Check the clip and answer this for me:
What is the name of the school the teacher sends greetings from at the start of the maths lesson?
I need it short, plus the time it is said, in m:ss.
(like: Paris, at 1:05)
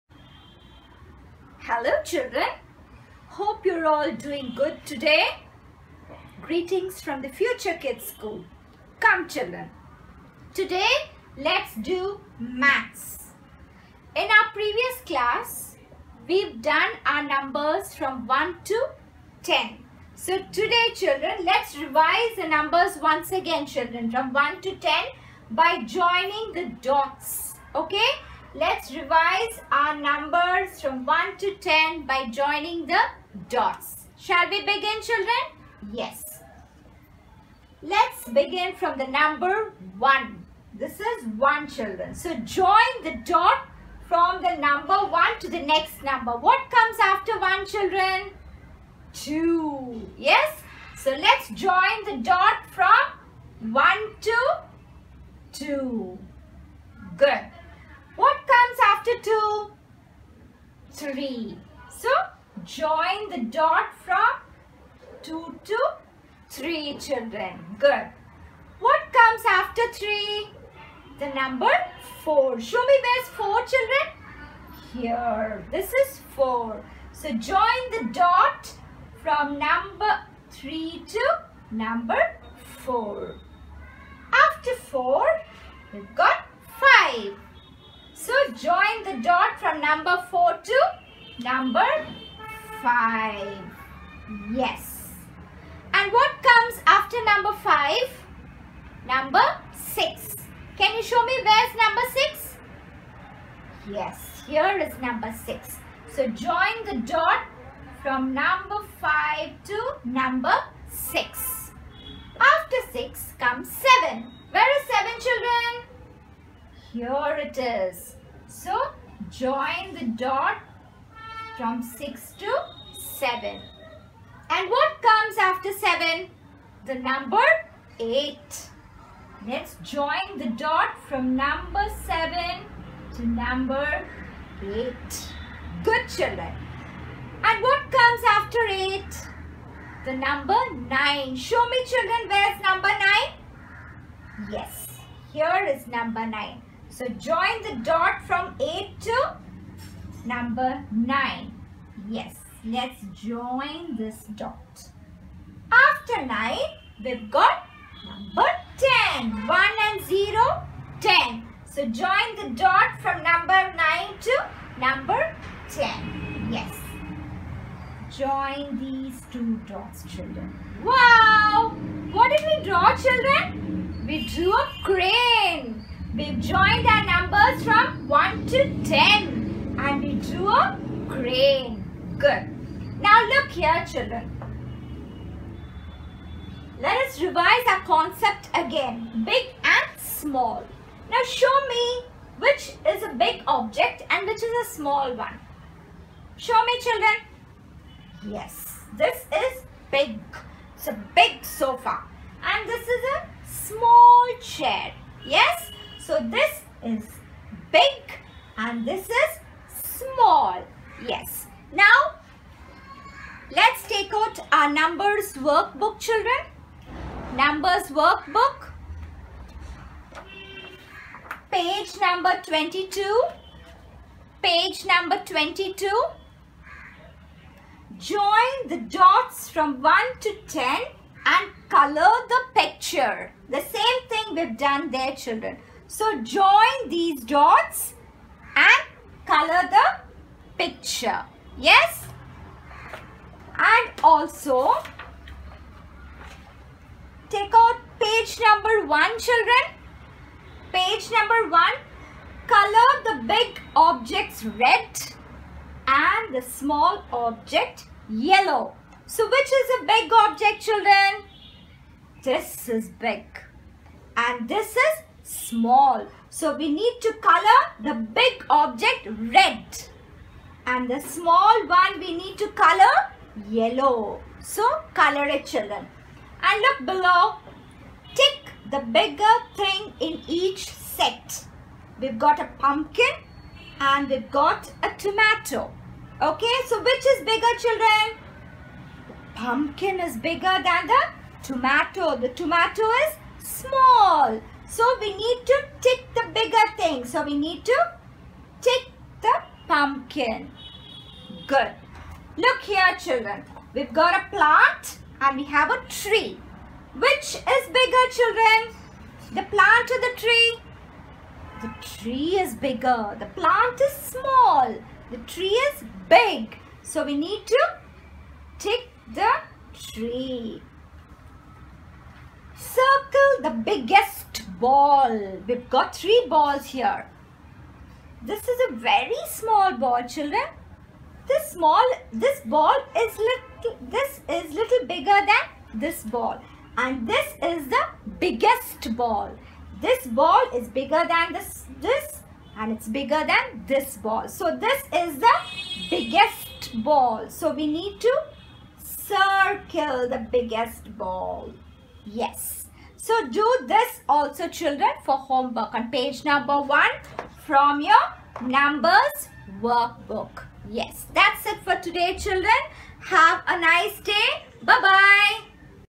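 Future Kids School, at 0:07.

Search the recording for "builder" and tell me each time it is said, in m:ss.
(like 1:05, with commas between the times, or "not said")
not said.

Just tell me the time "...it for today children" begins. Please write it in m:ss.
6:01.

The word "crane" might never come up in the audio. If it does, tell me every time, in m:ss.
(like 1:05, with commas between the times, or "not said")
2:54, 3:01.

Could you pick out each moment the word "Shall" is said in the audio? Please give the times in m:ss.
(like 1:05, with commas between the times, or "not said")
0:34.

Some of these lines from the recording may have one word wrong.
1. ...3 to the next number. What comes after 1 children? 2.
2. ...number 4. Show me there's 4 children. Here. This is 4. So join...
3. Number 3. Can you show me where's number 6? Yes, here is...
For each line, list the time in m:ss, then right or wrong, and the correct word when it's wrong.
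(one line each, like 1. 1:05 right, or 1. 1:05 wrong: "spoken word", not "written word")
1. 0:44 wrong: "1", not "3"
2. 1:11 right
3. 1:39 wrong: "6", not "3".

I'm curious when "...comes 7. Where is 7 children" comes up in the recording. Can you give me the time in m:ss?
1:53.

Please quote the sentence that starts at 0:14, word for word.
In our previous class we've done our numbers from 1 to 10.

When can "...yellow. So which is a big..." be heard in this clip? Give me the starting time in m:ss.
4:18.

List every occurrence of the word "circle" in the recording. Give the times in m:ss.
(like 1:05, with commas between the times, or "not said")
5:22, 5:48.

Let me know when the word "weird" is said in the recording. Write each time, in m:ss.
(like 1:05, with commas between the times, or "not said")
not said.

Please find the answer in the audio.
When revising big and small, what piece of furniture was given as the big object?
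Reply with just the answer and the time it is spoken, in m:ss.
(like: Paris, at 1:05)
Sofa, at 3:21.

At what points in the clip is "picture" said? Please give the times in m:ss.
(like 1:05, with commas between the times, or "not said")
3:52, 4:00.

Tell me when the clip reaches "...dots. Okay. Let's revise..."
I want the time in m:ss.
0:26.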